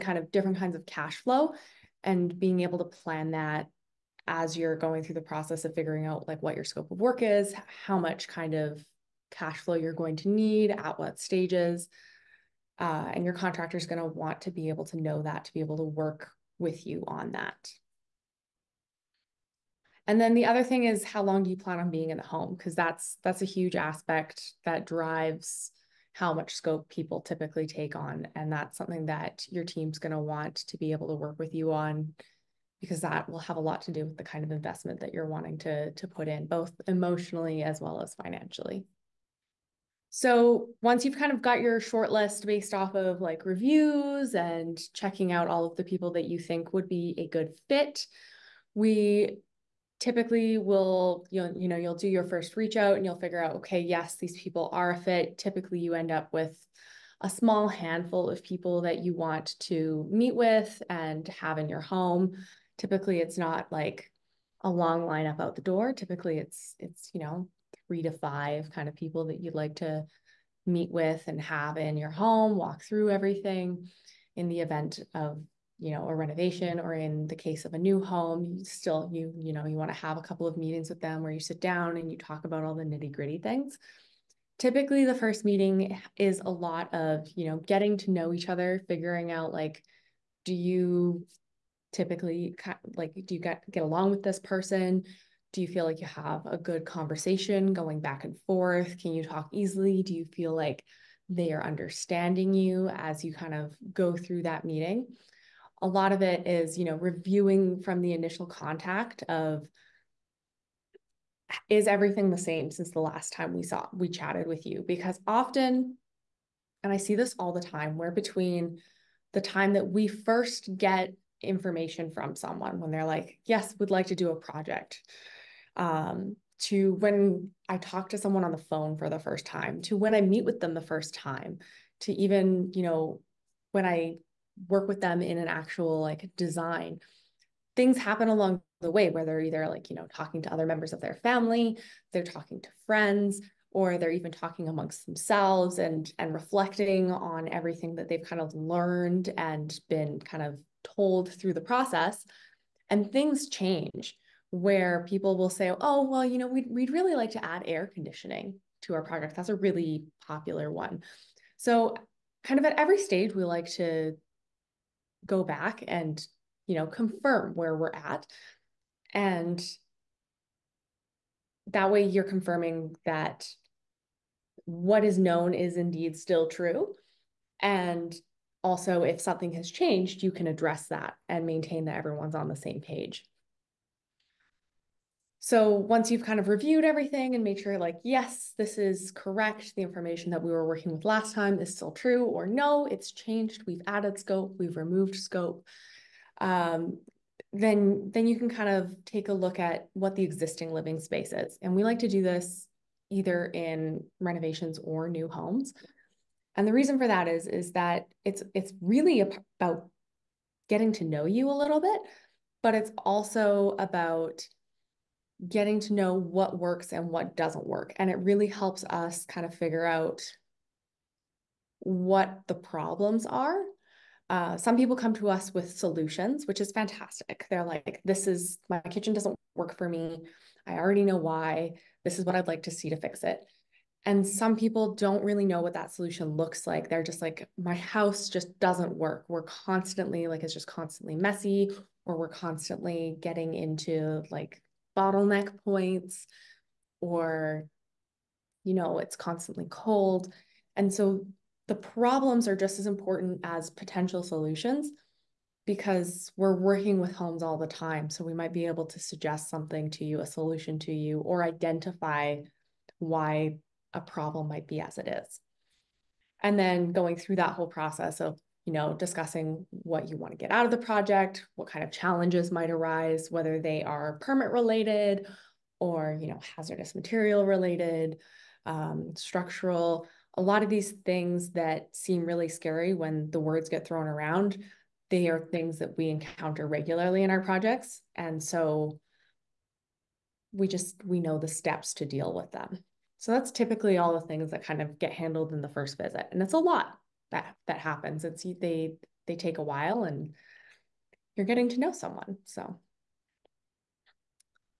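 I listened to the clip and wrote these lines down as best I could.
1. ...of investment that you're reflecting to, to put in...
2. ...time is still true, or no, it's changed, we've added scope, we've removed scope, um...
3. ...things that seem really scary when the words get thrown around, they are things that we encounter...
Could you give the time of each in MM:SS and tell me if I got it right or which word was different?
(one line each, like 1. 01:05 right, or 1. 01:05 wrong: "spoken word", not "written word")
1. 00:34 wrong: "wanting", not "reflecting"
2. 03:11 right
3. 04:41 right.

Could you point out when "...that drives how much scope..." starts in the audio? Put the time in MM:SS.
00:24.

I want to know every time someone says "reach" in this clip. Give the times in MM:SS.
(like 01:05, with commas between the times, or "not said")
00:52.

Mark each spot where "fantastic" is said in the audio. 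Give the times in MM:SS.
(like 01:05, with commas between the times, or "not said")
03:46.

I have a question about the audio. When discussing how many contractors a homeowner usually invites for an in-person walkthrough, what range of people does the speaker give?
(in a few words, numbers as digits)
3 to 5.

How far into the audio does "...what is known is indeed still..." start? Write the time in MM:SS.
02:54.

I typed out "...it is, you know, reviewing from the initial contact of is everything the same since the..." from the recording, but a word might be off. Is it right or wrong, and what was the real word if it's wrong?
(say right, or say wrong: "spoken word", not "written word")
right.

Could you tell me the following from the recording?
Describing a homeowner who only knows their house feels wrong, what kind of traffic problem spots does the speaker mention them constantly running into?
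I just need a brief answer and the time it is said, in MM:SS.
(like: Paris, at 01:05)
Bottleneck points, at 04:04.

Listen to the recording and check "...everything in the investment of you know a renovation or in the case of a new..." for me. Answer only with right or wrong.
wrong.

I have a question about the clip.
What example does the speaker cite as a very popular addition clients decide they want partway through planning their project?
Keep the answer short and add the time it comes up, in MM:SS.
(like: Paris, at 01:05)
Air conditioning, at 02:37.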